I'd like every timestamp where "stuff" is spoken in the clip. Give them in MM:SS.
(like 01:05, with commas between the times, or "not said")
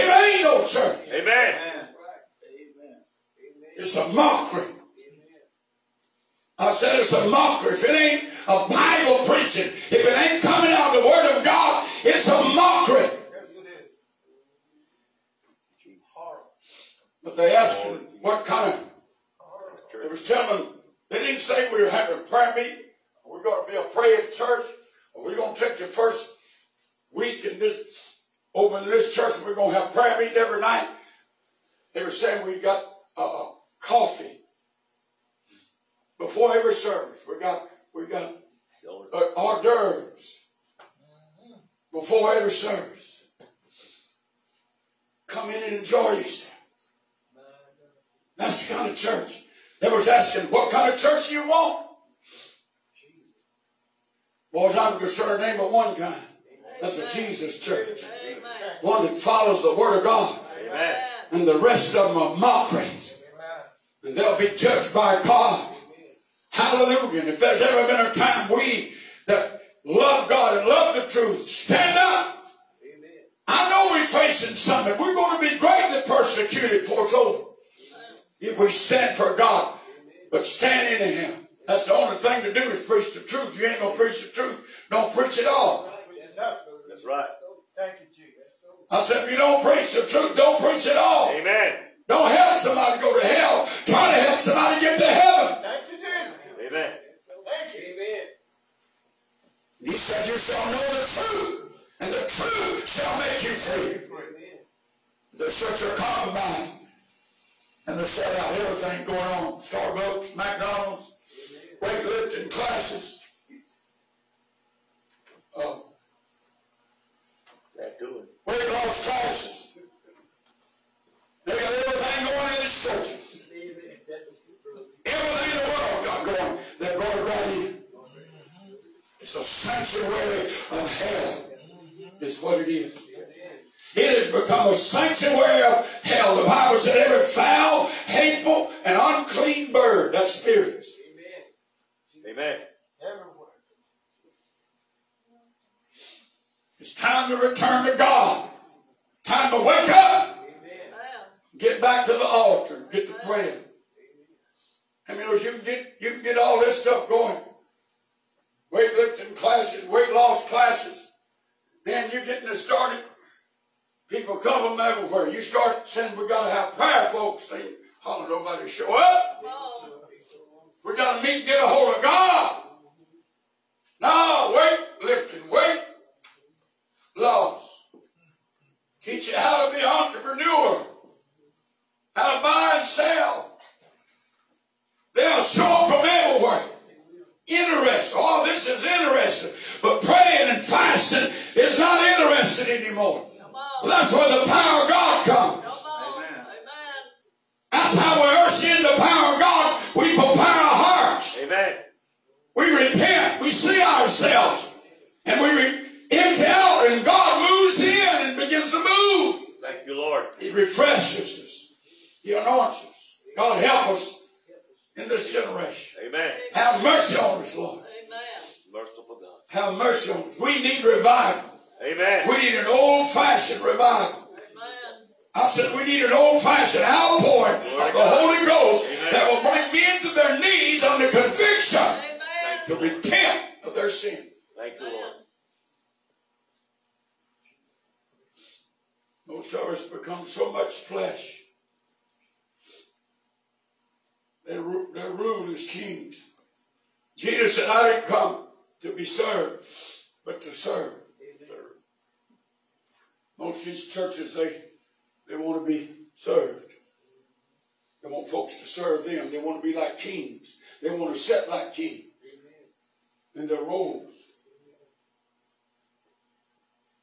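02:36.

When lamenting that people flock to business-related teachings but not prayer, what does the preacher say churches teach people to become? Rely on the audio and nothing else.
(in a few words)
An entrepreneur.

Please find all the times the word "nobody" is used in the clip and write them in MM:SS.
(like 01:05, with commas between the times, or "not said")
02:48.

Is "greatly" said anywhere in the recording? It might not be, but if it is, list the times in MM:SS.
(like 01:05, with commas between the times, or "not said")
01:15.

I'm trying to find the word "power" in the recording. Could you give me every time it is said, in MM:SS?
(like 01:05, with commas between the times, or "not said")
03:14, 03:18.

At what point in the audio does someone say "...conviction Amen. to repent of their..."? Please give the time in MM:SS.
03:51.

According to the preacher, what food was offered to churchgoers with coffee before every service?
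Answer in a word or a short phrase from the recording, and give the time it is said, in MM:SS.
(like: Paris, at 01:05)
Hors d'oeuvres, at 00:39.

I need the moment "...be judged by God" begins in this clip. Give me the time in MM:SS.
01:04.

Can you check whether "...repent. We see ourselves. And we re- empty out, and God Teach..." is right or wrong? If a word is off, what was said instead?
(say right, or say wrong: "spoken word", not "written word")
wrong: "Thank", not "Teach".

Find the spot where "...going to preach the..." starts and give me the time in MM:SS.
01:23.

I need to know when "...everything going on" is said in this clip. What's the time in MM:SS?
01:48.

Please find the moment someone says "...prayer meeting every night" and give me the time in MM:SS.
00:29.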